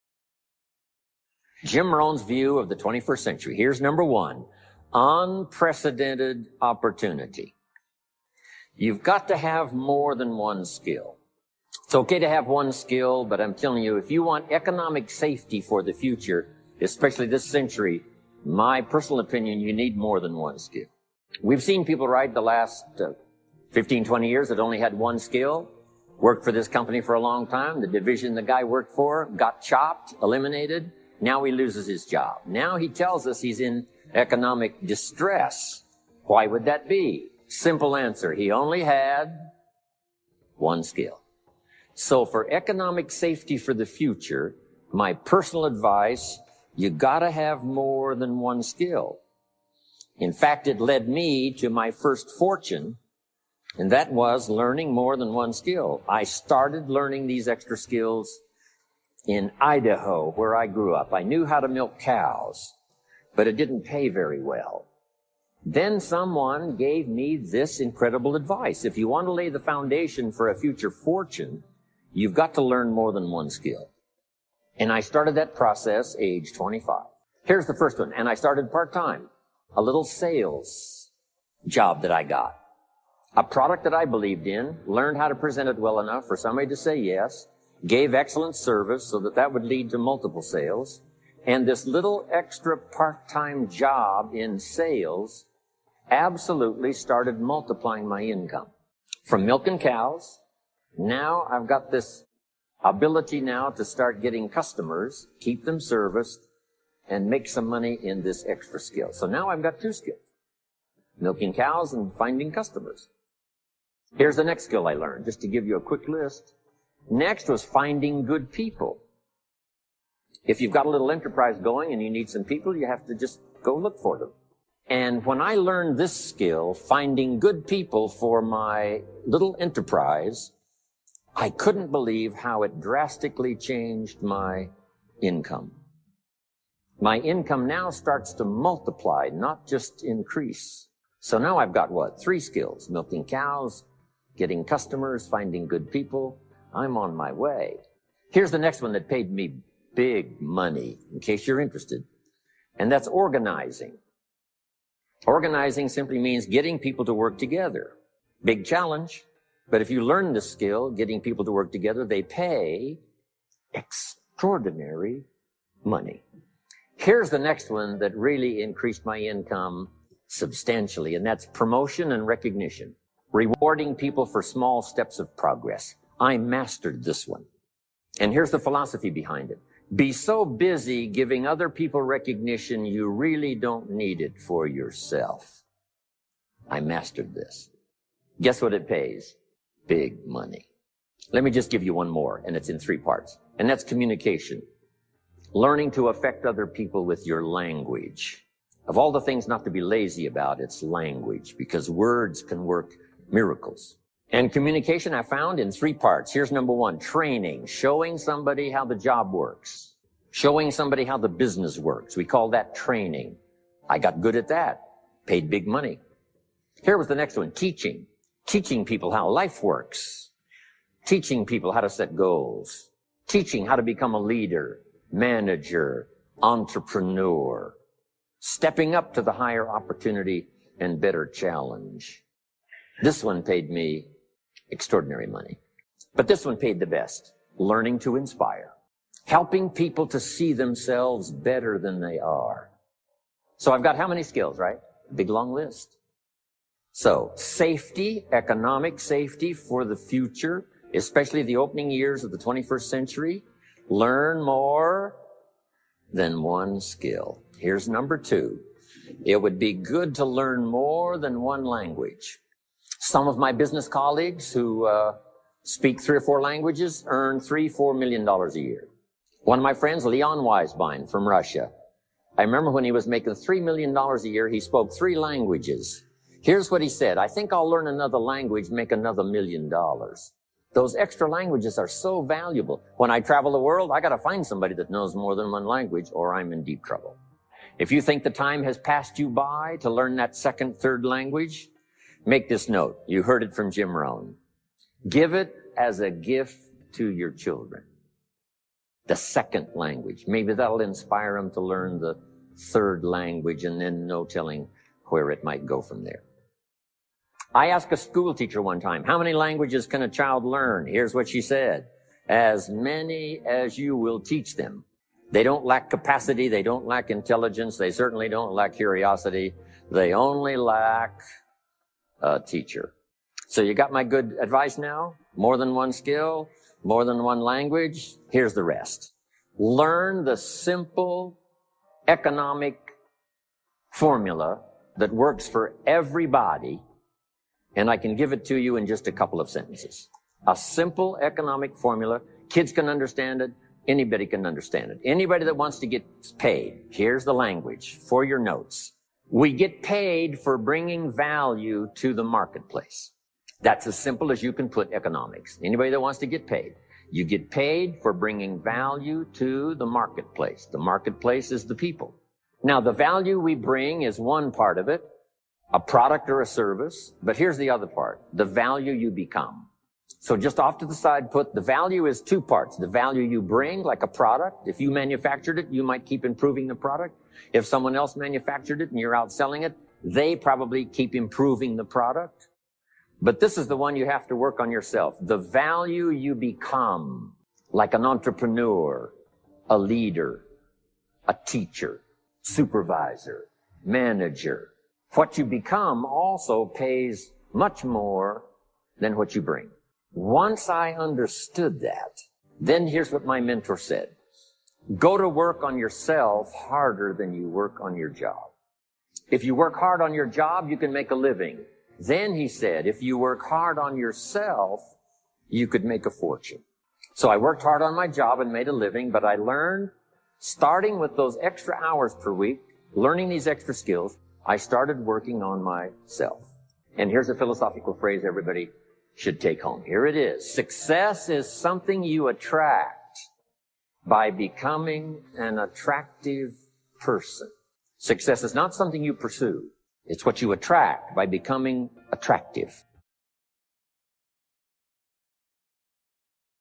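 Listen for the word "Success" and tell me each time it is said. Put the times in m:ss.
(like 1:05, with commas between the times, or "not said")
7:10, 7:17.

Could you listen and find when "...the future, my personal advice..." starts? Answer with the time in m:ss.
0:43.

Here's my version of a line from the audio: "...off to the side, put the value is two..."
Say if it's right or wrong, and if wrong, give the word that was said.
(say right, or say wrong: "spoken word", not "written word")
right.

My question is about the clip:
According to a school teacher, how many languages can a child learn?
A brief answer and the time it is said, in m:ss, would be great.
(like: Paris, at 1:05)
As many as you will teach them, at 5:12.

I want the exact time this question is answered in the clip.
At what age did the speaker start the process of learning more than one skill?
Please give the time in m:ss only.
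1:16.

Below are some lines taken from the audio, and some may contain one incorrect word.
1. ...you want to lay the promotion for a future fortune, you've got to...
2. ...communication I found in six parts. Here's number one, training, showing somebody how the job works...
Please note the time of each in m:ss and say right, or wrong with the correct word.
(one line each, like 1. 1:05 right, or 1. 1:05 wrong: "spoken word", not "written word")
1. 1:08 wrong: "foundation", not "promotion"
2. 3:24 wrong: "three", not "six".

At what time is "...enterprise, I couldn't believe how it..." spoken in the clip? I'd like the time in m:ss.
2:09.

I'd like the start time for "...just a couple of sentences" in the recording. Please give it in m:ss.
5:38.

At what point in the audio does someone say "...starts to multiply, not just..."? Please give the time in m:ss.
2:17.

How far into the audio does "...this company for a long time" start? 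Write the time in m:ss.
0:26.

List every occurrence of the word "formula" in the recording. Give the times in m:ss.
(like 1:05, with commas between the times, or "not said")
5:33, 5:41.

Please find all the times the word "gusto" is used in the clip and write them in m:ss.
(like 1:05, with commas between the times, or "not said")
not said.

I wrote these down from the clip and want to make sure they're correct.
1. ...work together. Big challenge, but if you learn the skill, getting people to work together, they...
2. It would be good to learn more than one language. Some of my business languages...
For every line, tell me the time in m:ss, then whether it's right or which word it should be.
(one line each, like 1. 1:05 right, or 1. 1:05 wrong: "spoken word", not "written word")
1. 2:37 right
2. 4:19 wrong: "colleagues", not "languages".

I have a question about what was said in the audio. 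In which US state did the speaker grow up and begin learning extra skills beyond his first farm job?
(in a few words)
Idaho.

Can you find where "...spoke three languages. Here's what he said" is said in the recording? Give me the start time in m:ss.
4:34.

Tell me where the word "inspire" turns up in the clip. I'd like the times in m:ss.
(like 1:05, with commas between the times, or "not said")
3:58, 5:00.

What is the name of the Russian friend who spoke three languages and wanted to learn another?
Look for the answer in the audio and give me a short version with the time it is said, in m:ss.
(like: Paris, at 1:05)
Leon Weisbein, at 4:30.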